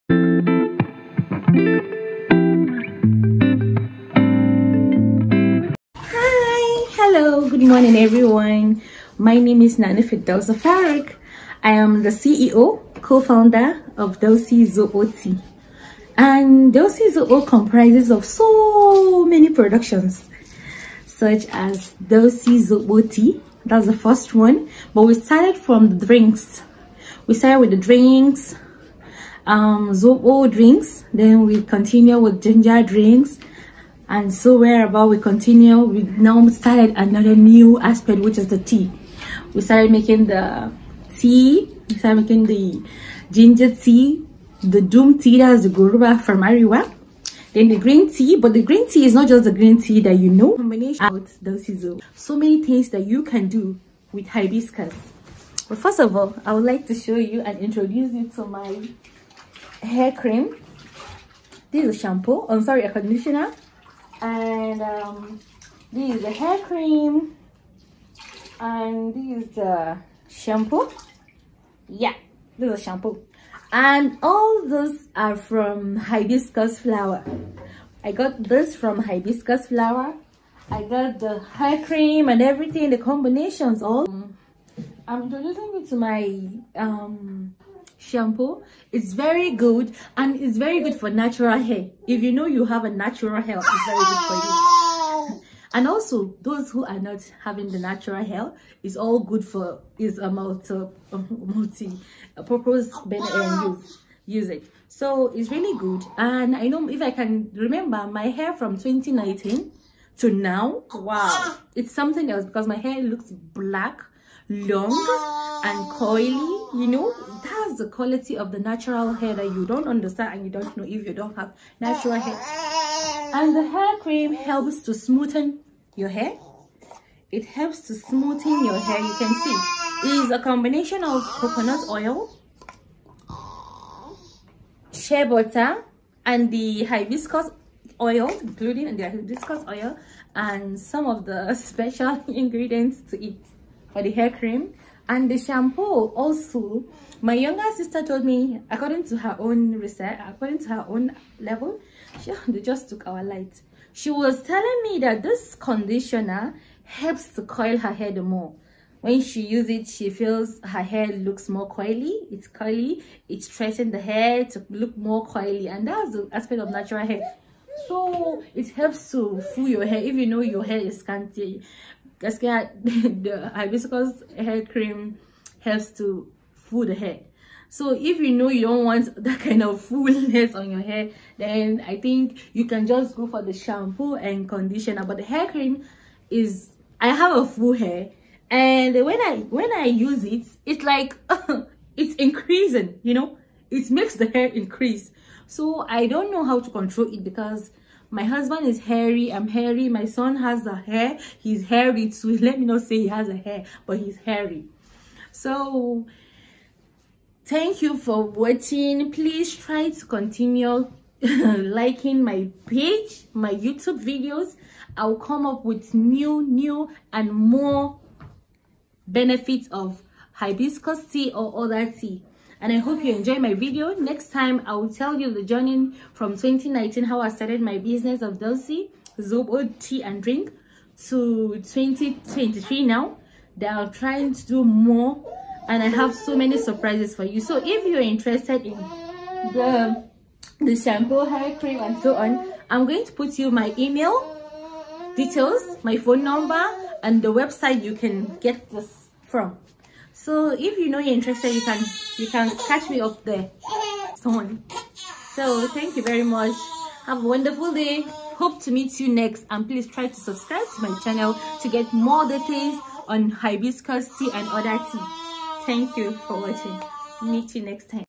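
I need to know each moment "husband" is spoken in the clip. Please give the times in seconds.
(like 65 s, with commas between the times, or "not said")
198 s.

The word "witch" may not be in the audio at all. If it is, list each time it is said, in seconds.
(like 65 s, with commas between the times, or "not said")
not said.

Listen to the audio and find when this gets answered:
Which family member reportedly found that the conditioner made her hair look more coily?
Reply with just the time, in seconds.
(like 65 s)
147 s.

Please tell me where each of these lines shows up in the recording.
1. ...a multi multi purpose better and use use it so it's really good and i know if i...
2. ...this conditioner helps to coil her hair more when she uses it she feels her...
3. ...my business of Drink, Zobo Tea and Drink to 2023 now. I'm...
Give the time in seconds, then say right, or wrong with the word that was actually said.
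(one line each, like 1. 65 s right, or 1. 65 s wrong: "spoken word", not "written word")
1. 100 s right
2. 155 s right
3. 227 s wrong: "Dausy", not "Drink".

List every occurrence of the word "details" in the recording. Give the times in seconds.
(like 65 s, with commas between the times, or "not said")
245 s, 262 s.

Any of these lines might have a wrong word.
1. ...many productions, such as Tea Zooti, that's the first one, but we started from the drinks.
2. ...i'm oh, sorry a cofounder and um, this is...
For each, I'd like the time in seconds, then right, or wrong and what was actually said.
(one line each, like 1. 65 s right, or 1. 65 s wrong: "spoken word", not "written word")
1. 19 s wrong: "Dausy", not "Tea"
2. 62 s wrong: "conditioner", not "cofounder".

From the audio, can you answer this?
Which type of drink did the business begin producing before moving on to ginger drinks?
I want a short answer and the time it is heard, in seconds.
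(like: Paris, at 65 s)
Zobo drinks, at 29 s.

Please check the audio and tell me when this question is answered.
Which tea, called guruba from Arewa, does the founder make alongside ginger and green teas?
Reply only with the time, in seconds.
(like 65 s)
44 s.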